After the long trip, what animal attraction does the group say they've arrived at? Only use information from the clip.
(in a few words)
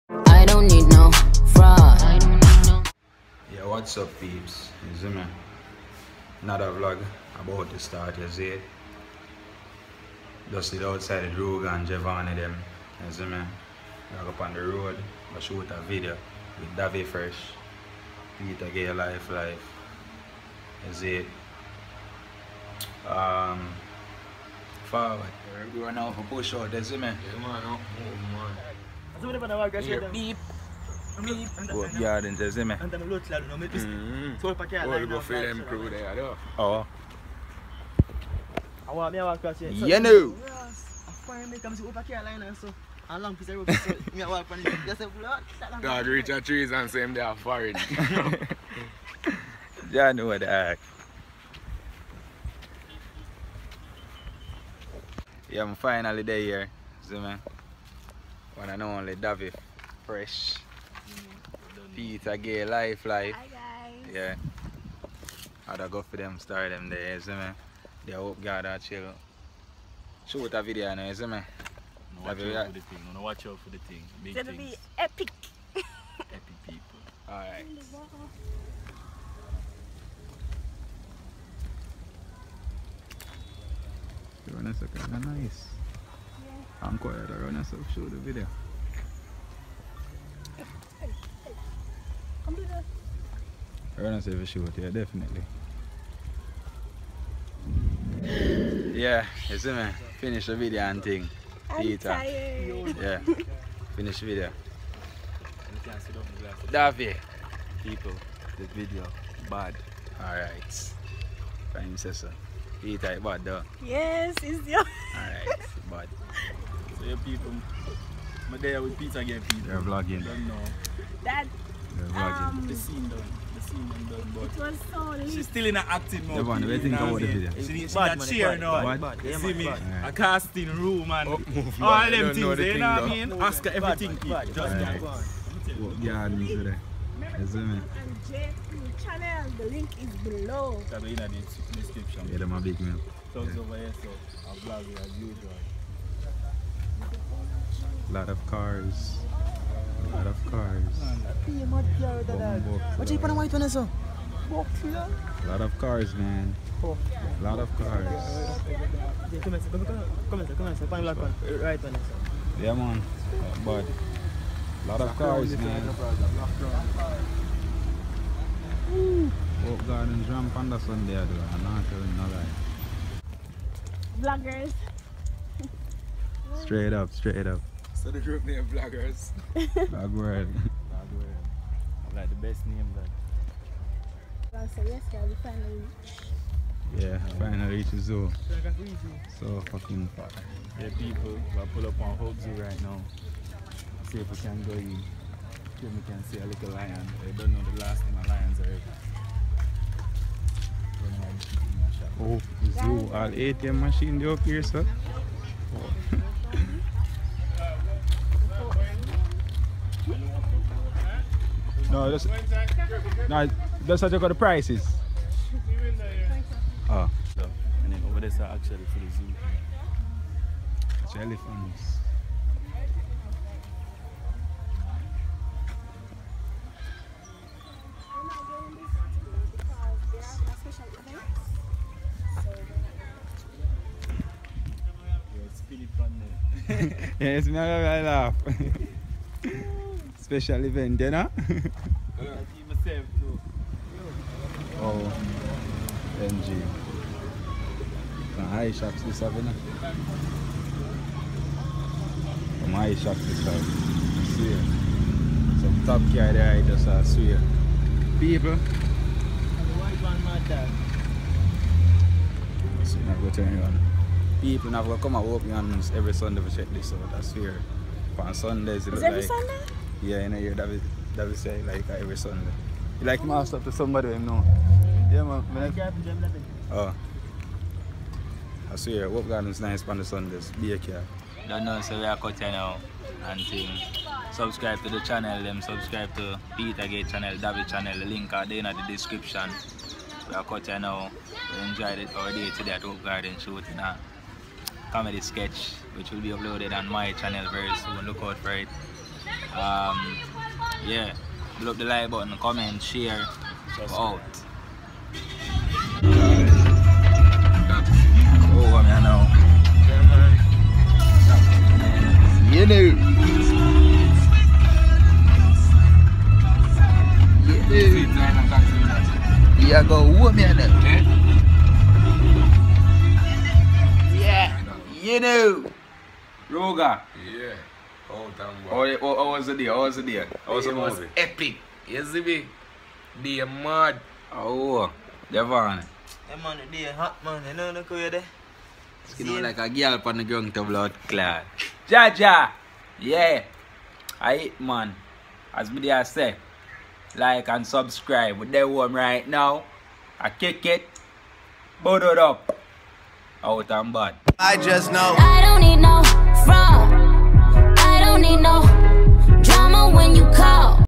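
Hope Zoo.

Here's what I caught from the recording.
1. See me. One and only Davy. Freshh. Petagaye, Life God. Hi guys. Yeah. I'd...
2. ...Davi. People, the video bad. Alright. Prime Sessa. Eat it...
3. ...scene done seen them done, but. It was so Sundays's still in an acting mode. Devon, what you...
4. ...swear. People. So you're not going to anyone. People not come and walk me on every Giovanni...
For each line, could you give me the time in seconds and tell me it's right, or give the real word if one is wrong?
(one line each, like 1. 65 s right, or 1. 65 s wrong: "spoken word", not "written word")
1. 57 s wrong: "Life", not "God"
2. 106 s right
3. 122 s wrong: "She", not "Sundays"
4. 257 s wrong: "Sunday", not "Giovanni".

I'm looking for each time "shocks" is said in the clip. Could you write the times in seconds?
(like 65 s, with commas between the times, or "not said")
248 s, 252 s.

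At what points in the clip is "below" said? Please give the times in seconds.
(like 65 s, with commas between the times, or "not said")
140 s, 301 s.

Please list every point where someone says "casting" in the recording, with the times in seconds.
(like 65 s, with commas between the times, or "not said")
130 s.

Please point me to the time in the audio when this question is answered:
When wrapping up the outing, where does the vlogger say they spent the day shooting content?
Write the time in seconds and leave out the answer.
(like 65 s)
292 s.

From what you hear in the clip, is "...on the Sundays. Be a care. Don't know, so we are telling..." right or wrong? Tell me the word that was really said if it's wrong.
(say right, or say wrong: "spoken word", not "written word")
wrong: "cutting", not "telling".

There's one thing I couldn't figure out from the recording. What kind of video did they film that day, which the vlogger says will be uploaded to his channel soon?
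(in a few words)
comedy sketch.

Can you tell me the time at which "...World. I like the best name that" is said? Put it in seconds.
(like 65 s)
181 s.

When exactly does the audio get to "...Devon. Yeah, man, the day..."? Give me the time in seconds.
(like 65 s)
335 s.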